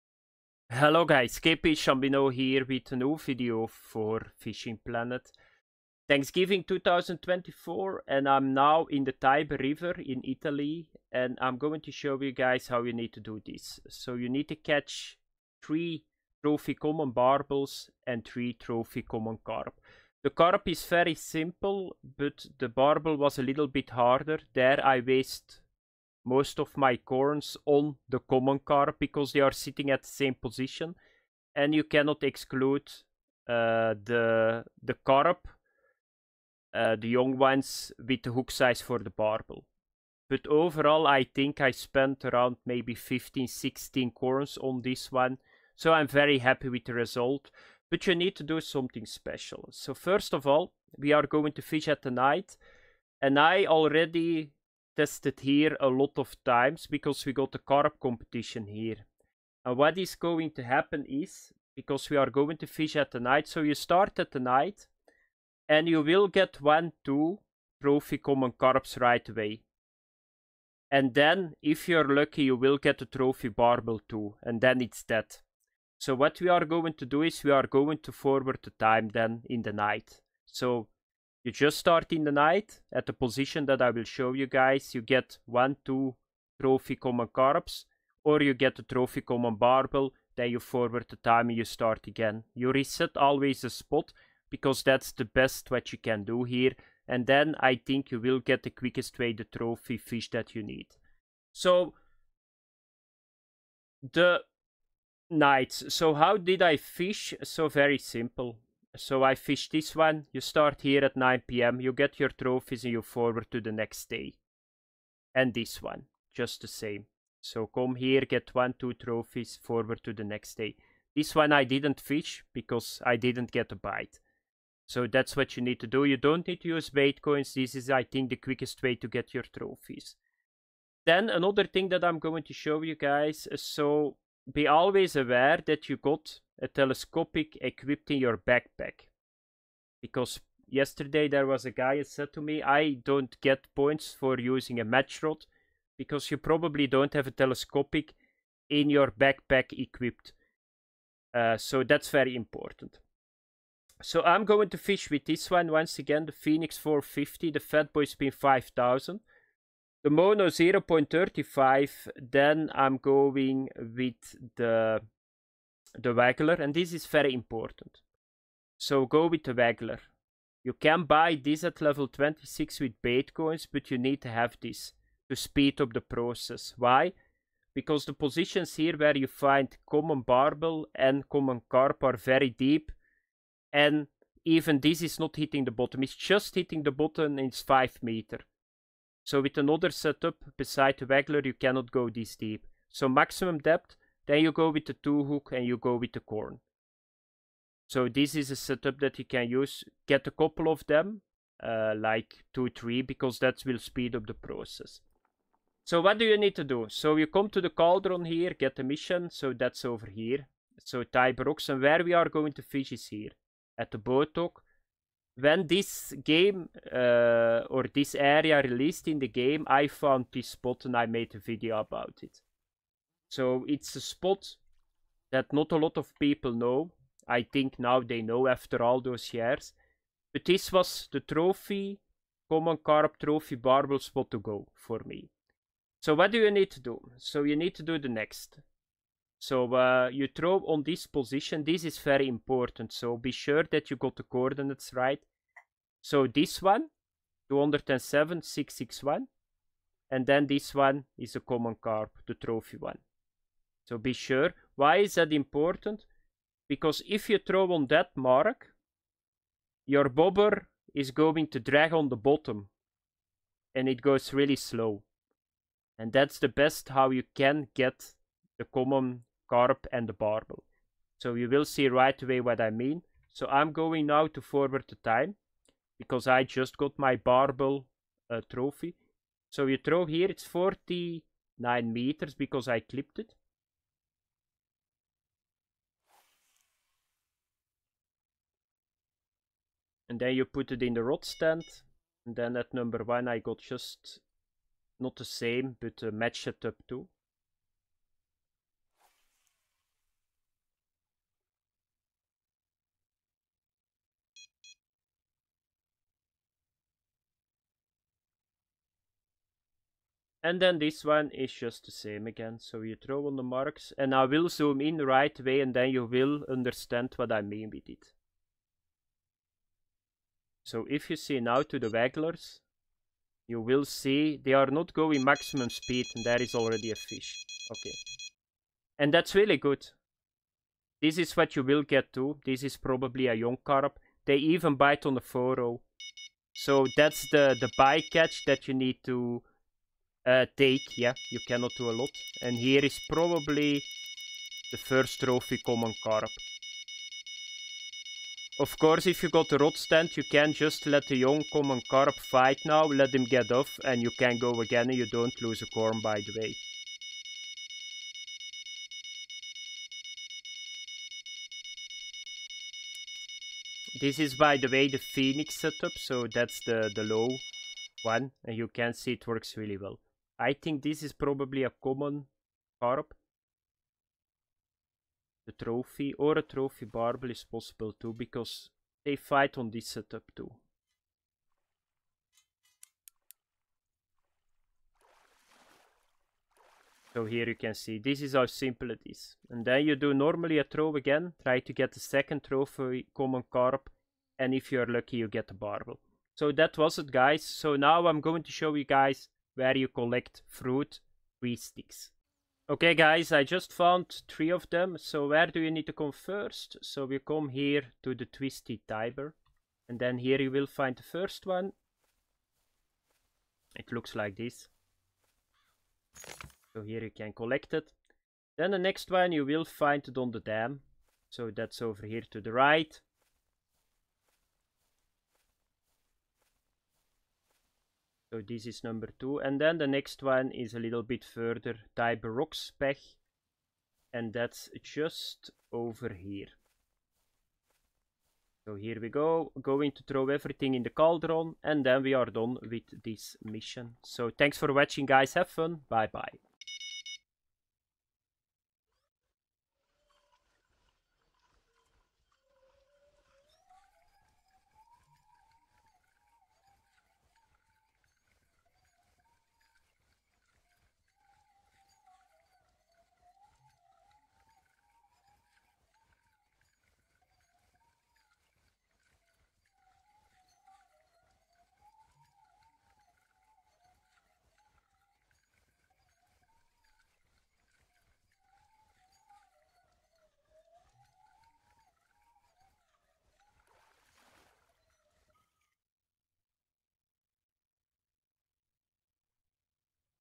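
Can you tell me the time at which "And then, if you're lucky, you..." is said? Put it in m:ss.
1:10.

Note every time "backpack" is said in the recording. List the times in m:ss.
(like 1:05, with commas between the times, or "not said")
2:18, 2:29.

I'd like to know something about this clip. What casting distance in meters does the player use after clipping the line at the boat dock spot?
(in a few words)
49 meters.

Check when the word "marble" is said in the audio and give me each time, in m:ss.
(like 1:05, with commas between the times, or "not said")
not said.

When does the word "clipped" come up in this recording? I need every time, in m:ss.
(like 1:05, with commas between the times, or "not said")
4:42.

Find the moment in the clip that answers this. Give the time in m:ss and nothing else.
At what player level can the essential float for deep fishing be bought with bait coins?
2:51.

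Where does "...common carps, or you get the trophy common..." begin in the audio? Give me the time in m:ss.
1:26.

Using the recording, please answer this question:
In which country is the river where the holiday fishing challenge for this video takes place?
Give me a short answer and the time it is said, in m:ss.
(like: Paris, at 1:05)
Italy, at 0:10.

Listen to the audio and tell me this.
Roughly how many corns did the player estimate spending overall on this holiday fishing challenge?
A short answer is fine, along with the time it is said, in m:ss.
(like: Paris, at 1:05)
15 or 16, at 0:42.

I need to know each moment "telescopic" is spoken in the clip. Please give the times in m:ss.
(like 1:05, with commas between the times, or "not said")
2:16, 2:27.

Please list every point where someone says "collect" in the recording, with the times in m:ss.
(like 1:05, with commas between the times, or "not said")
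6:39, 6:57.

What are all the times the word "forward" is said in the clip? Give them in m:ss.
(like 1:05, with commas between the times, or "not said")
1:18, 1:30, 1:53, 1:59, 4:34.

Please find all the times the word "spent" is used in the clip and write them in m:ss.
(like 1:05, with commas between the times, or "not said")
0:41.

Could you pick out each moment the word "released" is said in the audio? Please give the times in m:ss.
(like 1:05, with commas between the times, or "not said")
3:38.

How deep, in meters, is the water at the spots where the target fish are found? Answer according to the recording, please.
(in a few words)
5 meters.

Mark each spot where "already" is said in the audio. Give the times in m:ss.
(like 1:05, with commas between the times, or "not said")
0:53, 5:26.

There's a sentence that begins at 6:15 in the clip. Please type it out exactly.
The trophy or a trophy barbel is possible too because they fight on this setup too.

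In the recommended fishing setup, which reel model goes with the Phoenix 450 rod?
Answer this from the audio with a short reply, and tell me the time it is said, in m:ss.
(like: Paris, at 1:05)
Fatboy Spin 5000, at 2:37.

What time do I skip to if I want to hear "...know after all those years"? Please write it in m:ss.
3:48.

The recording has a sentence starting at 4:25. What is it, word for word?
And that's the best how you can get the common carp and the barbel.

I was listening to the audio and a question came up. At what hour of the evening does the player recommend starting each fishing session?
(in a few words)
9 p.m.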